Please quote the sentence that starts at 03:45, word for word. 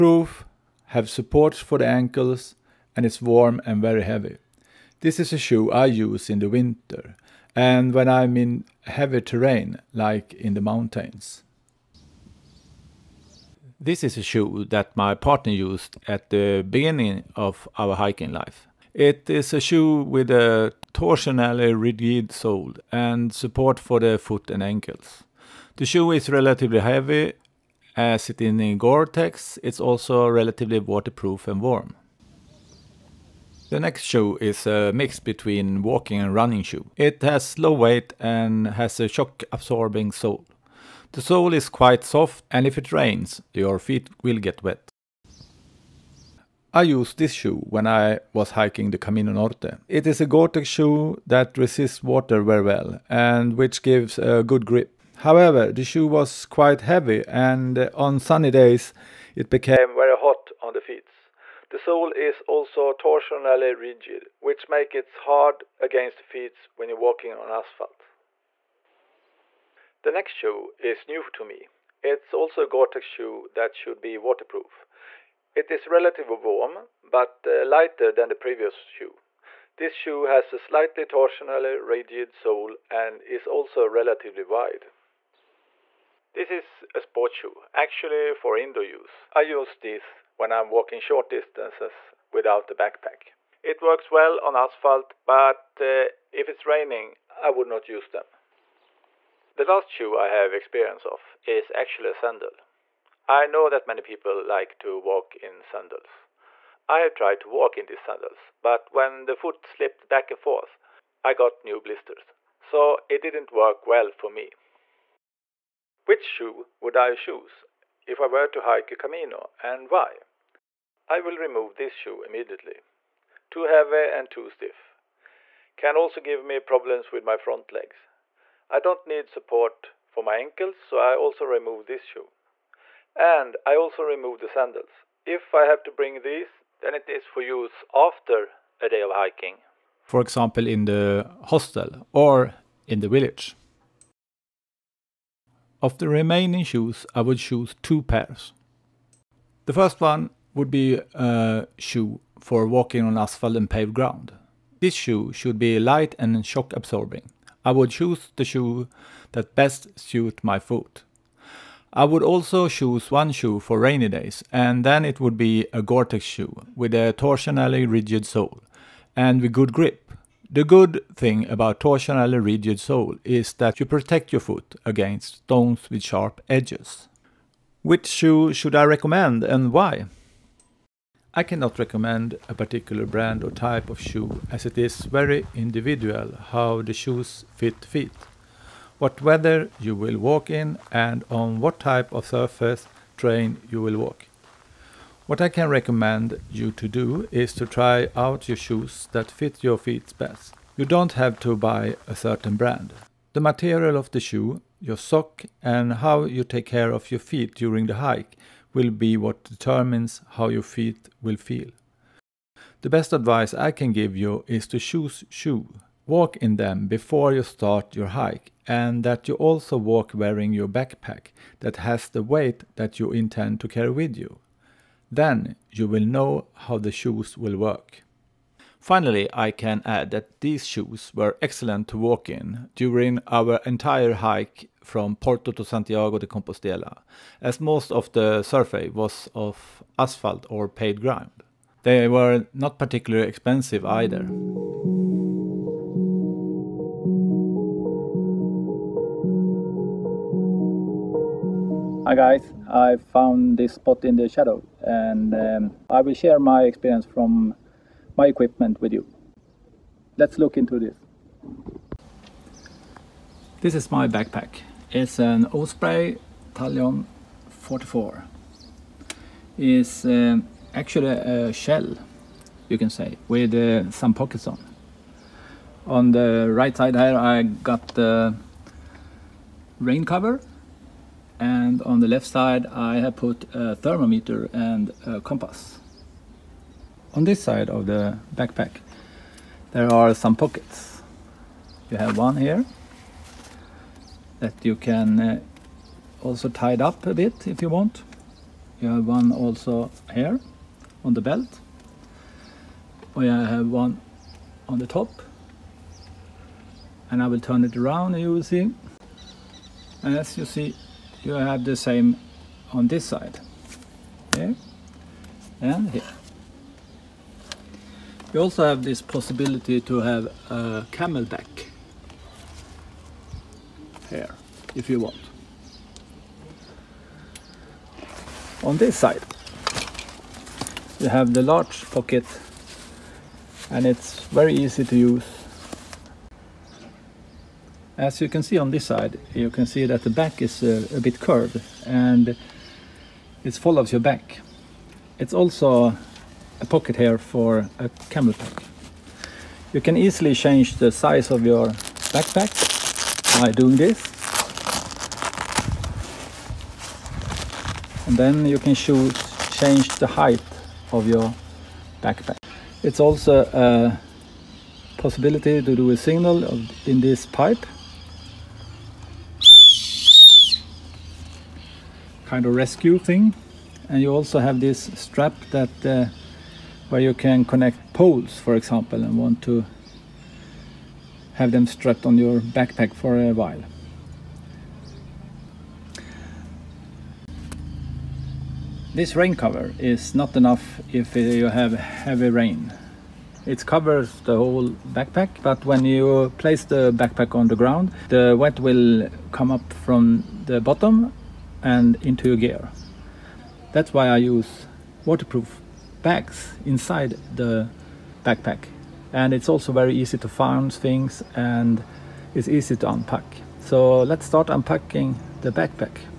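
Then you will know how the shoes will work.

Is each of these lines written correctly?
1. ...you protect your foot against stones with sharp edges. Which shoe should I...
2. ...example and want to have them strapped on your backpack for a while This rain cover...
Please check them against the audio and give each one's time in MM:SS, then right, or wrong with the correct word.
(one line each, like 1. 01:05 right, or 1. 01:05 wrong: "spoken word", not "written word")
1. 02:53 right
2. 06:18 right.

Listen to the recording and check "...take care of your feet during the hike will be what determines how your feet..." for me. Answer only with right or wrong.
right.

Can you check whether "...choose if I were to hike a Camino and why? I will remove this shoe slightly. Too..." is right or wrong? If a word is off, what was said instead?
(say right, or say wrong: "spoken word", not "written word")
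wrong: "immediately", not "slightly".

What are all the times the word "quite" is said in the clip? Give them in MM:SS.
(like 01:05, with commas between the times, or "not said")
00:41, 00:56.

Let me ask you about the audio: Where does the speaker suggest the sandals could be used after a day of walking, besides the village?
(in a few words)
the hostel.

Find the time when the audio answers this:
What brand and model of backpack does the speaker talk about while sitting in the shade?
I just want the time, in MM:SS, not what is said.
04:25.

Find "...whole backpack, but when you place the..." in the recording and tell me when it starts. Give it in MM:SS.
06:34.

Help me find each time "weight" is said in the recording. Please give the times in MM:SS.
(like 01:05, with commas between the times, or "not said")
00:37, 03:42.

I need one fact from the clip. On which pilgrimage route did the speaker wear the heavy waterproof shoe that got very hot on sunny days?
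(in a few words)
Camino Norte.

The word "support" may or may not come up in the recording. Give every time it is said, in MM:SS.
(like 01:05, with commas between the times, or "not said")
00:01, 00:23, 02:09.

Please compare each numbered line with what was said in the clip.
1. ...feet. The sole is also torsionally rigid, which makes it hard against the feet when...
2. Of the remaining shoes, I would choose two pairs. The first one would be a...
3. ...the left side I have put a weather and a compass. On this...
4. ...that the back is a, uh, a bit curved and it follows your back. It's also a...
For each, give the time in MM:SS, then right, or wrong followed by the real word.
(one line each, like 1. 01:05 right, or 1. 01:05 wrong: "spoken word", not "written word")
1. 01:00 right
2. 02:25 right
3. 04:41 wrong: "thermometer", not "weather"
4. 05:39 right.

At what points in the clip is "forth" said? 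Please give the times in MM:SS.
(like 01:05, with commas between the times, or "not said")
01:50.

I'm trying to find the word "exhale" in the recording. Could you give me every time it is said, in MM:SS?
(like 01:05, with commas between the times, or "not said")
not said.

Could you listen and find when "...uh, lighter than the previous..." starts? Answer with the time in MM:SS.
01:17.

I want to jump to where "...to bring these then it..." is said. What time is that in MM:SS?
02:15.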